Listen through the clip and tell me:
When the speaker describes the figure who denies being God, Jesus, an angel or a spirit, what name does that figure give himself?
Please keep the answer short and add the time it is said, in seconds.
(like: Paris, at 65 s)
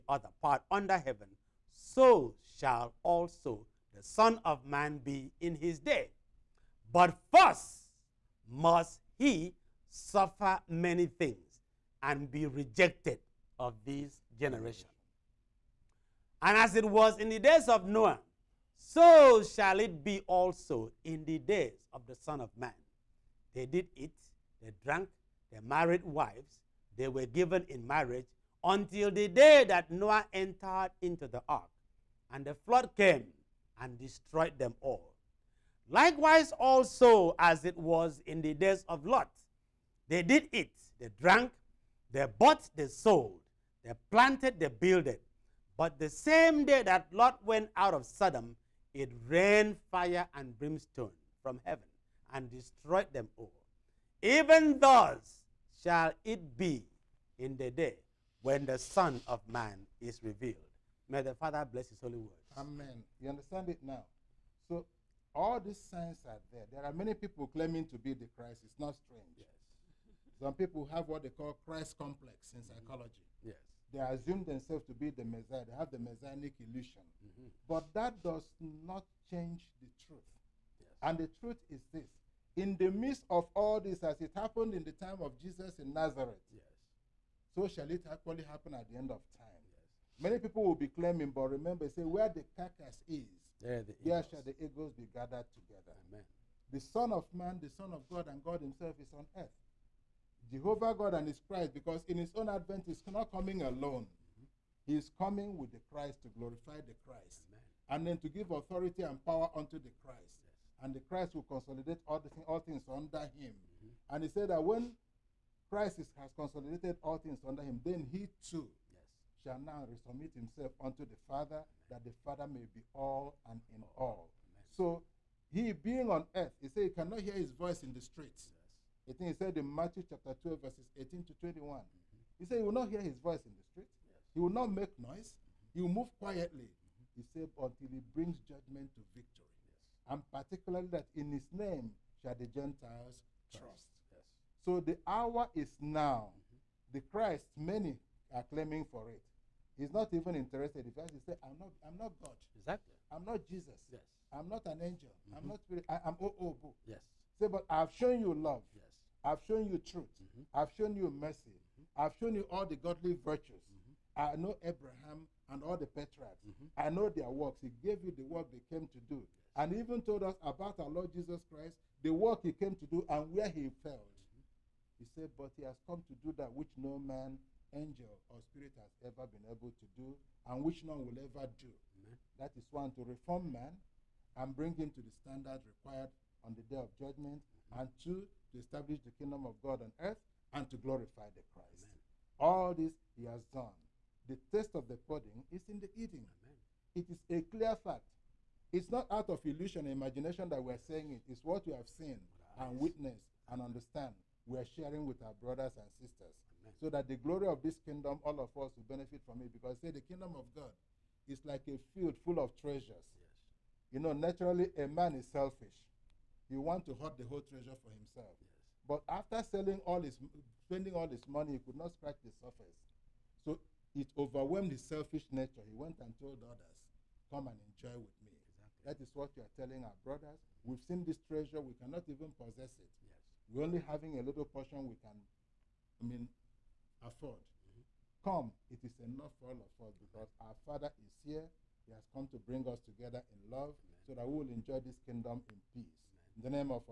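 Obu, at 156 s.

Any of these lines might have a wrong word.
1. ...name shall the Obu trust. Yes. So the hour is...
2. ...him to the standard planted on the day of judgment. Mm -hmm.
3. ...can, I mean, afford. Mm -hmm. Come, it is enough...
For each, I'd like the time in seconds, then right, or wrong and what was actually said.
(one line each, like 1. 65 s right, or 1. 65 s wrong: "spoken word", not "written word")
1. 141 s wrong: "Gentiles", not "Obu"
2. 184 s wrong: "required", not "planted"
3. 235 s right.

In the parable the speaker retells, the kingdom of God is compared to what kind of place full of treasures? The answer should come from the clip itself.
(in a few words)
A field.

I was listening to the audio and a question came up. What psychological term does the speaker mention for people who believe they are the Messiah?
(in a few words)
Christ complex.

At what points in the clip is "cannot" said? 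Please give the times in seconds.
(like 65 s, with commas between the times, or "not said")
126 s, 231 s.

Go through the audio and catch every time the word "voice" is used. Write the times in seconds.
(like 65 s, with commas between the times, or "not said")
127 s, 133 s.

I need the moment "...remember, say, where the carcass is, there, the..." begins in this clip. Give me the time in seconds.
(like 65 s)
91 s.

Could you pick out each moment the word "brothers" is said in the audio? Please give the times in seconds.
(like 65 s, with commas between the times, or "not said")
205 s, 230 s.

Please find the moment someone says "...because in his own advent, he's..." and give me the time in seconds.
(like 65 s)
101 s.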